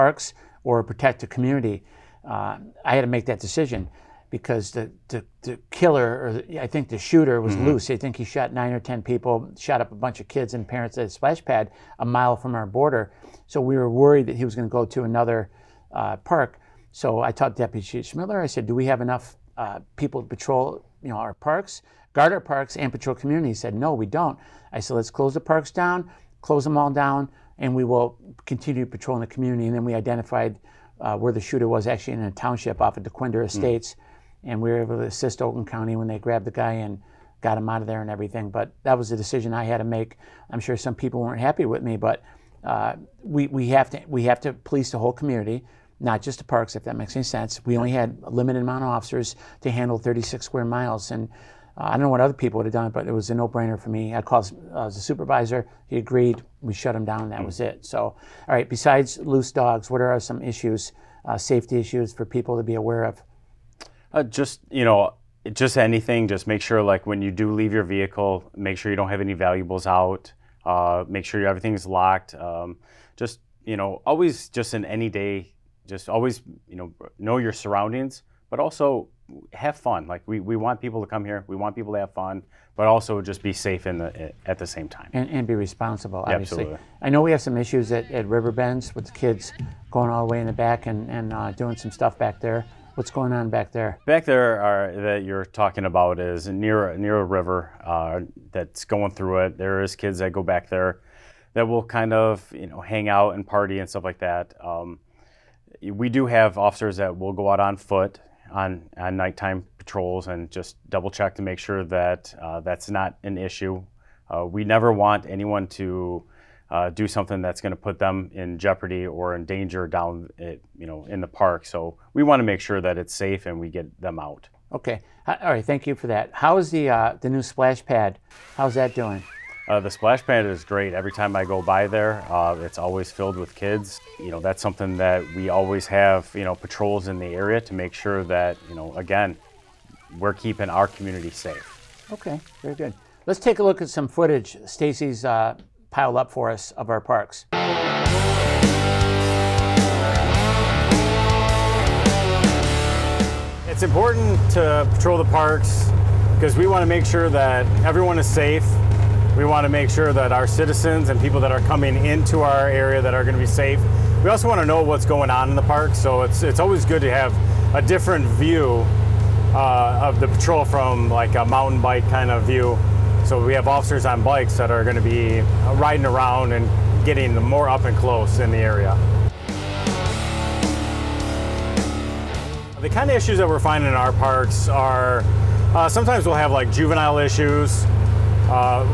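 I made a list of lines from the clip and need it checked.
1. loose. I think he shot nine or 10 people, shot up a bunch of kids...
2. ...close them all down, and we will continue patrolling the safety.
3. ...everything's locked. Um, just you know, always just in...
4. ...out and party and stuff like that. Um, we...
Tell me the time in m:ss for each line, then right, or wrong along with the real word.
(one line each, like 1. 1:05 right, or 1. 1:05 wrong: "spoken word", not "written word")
1. 0:07 right
2. 0:26 wrong: "community", not "safety"
3. 1:11 right
4. 1:43 right.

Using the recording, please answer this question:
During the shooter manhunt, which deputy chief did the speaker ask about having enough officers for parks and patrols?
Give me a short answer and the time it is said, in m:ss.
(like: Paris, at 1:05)
Schmidler, at 0:17.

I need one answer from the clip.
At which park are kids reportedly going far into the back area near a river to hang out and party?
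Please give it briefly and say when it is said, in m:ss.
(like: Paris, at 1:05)
Riverbends, at 1:28.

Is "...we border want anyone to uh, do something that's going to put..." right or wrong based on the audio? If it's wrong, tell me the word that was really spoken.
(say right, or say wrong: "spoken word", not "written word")
wrong: "never", not "border".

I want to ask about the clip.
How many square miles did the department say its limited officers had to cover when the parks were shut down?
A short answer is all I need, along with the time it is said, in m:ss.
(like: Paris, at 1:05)
36, at 0:49.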